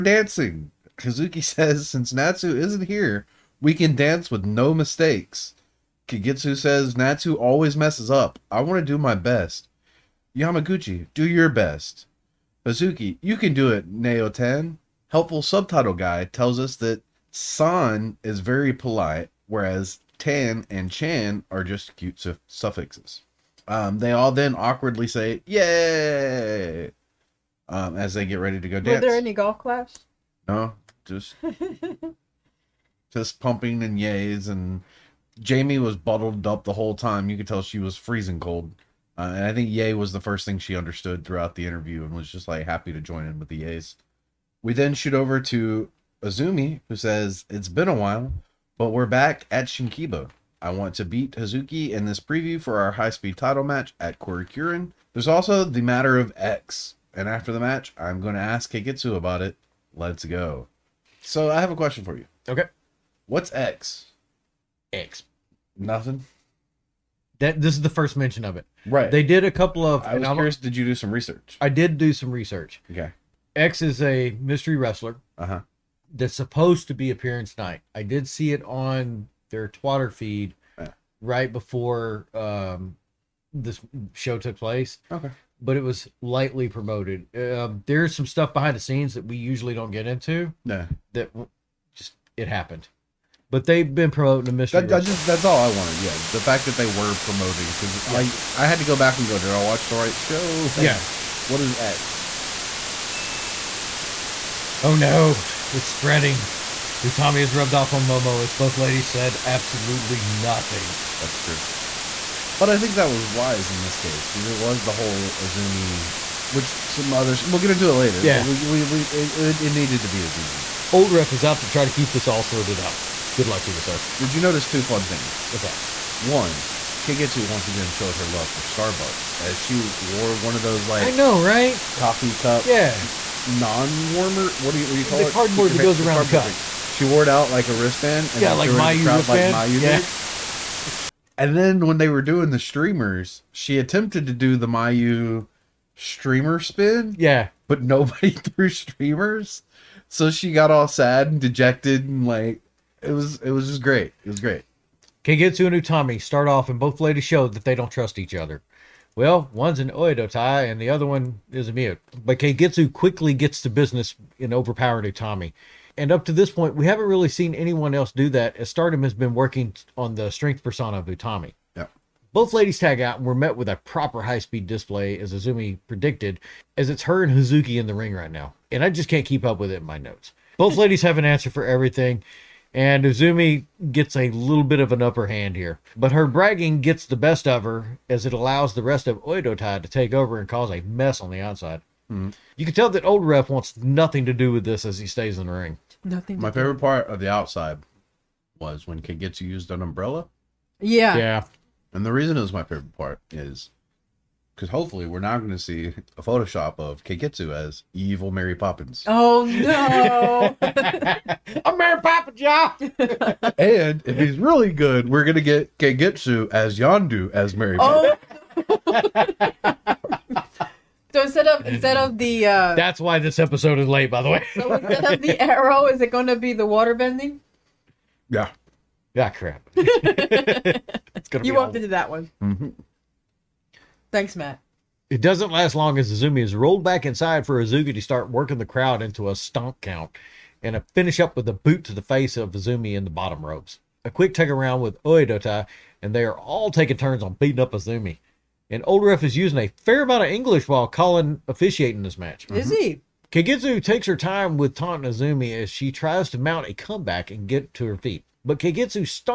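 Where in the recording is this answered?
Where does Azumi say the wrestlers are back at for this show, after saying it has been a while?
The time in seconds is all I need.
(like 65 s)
49 s.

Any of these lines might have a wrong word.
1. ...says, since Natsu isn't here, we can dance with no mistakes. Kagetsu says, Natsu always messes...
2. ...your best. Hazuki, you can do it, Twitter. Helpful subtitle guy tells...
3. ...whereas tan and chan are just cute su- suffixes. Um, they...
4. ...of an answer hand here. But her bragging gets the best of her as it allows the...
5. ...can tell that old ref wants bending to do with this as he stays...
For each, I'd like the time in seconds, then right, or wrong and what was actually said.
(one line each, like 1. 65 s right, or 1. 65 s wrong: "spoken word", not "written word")
1. 1 s right
2. 11 s wrong: "Naoten", not "Twitter"
3. 19 s right
4. 184 s wrong: "upper", not "answer"
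5. 192 s wrong: "nothing", not "bending".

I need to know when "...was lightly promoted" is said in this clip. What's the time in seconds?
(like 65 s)
85 s.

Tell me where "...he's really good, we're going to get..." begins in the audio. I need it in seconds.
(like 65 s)
214 s.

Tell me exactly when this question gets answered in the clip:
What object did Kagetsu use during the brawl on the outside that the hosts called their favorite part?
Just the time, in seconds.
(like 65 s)
199 s.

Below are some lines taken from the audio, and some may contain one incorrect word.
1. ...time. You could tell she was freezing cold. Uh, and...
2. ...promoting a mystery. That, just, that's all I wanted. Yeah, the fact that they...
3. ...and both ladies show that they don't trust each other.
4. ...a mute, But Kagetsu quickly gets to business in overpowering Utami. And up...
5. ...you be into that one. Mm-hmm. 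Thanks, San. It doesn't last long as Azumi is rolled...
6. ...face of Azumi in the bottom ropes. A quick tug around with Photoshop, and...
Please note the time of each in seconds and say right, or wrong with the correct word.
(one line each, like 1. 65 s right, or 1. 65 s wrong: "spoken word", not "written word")
1. 36 s right
2. 94 s right
3. 156 s right
4. 161 s right
5. 231 s wrong: "Matt", not "San"
6. 242 s wrong: "Oedotai", not "Photoshop".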